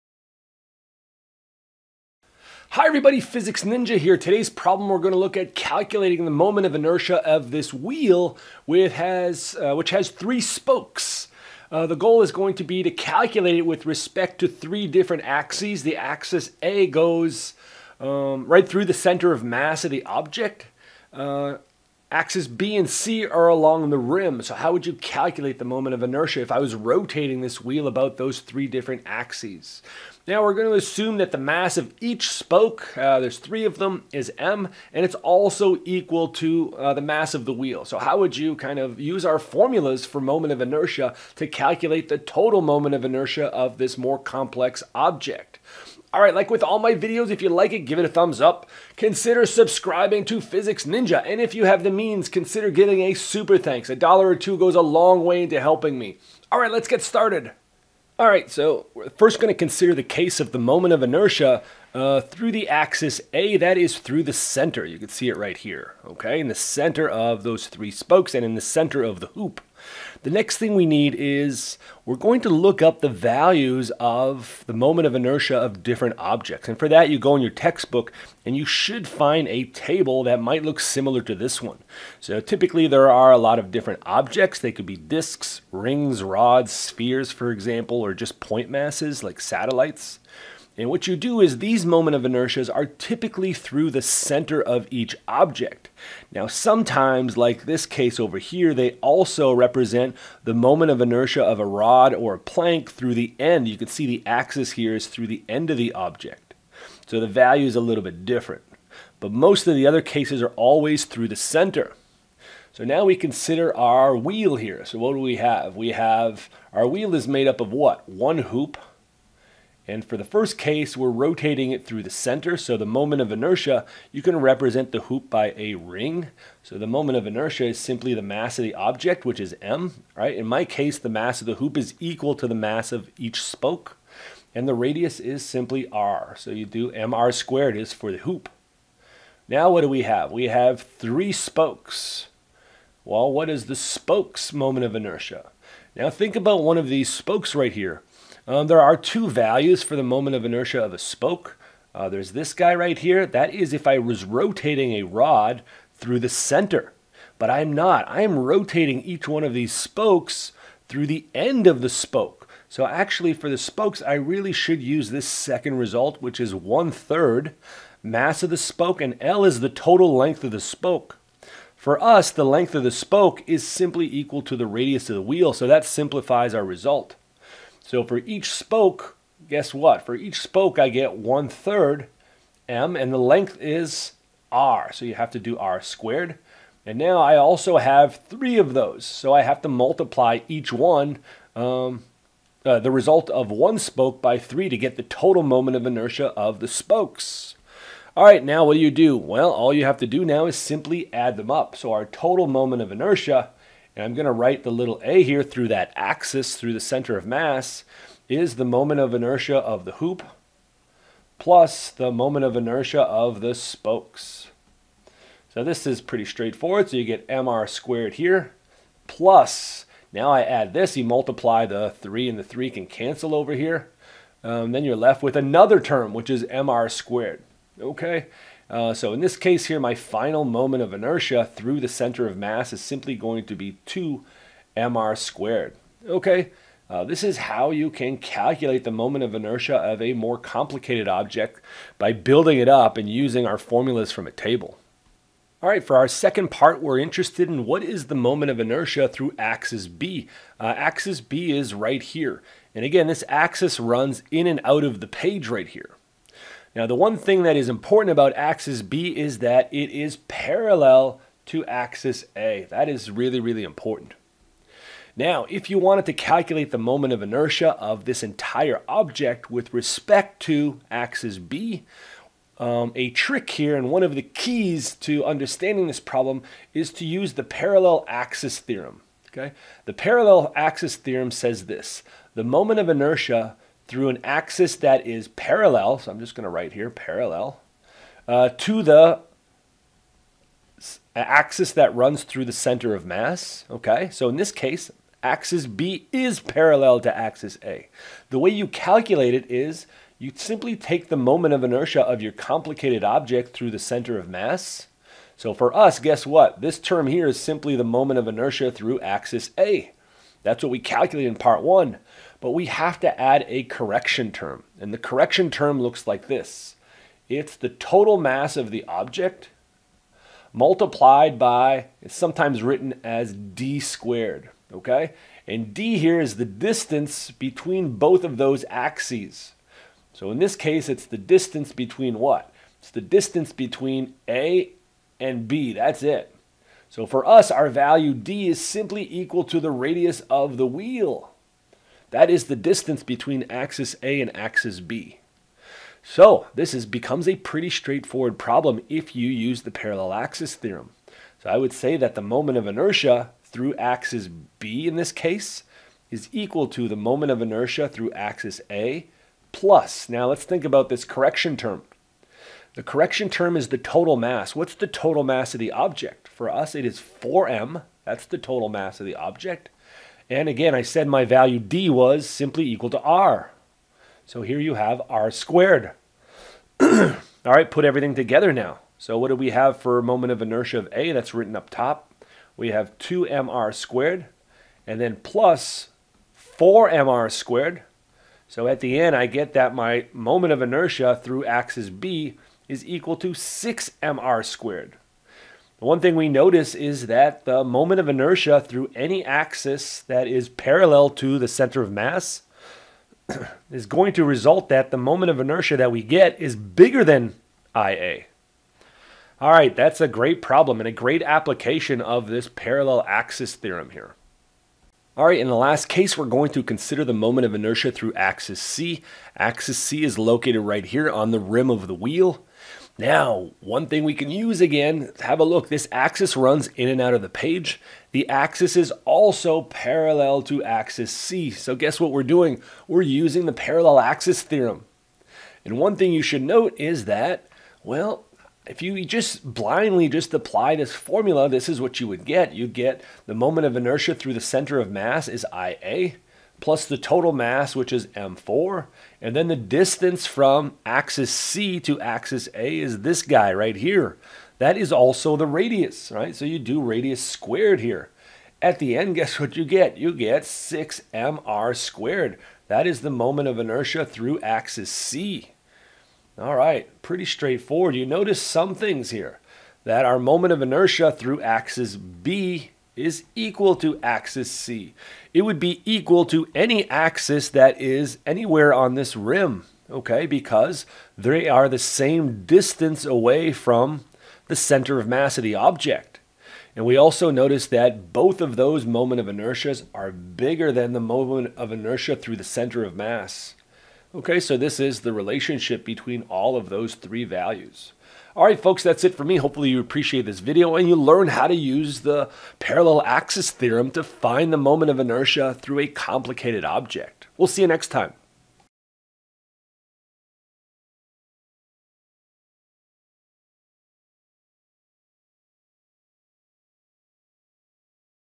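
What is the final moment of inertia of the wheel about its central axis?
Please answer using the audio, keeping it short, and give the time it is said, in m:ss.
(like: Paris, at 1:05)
2mr squared, at 3:53.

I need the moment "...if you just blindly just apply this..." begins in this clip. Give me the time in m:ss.
7:18.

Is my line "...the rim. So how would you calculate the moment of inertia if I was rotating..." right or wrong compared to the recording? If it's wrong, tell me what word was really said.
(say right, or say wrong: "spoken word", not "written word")
right.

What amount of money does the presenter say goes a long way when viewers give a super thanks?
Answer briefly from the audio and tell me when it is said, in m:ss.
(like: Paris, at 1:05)
a dollar or two, at 0:53.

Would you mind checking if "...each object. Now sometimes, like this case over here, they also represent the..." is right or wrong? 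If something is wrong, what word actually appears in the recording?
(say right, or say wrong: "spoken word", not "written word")
right.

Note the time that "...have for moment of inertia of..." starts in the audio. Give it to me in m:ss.
6:19.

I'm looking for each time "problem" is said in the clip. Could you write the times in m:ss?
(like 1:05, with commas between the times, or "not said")
0:04, 4:35, 5:48, 6:50.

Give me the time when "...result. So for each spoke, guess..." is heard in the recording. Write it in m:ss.
2:56.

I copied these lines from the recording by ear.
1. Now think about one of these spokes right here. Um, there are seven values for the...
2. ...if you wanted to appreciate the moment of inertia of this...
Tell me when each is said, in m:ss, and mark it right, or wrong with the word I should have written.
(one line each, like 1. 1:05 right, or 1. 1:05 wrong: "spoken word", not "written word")
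1. 2:25 wrong: "two", not "seven"
2. 4:25 wrong: "calculate", not "appreciate".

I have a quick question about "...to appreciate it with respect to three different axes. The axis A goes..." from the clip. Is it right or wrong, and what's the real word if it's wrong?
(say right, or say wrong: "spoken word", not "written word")
wrong: "calculate", not "appreciate".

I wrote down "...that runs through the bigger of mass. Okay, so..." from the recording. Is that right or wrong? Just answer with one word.
wrong.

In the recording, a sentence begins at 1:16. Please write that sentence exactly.
And for that, you go in your textbook and you should find a table that might look similar to this one.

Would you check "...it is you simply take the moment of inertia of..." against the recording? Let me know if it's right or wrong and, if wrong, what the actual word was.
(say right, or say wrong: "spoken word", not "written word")
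right.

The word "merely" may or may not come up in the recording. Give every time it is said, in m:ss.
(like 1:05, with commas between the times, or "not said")
not said.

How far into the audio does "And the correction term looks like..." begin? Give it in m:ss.
5:14.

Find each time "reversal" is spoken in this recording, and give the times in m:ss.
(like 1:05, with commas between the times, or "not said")
not said.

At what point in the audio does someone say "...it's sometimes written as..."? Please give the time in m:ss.
5:22.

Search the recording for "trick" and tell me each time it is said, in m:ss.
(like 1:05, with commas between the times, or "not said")
4:33.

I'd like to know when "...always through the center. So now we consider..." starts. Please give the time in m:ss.
1:50.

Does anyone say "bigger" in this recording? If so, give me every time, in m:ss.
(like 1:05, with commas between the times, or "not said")
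6:46, 8:10.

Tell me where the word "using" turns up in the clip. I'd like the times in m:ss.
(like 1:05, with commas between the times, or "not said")
4:03, 7:13.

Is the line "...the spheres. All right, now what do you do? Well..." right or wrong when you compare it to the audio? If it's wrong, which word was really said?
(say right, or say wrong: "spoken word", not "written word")
wrong: "spokes", not "spheres".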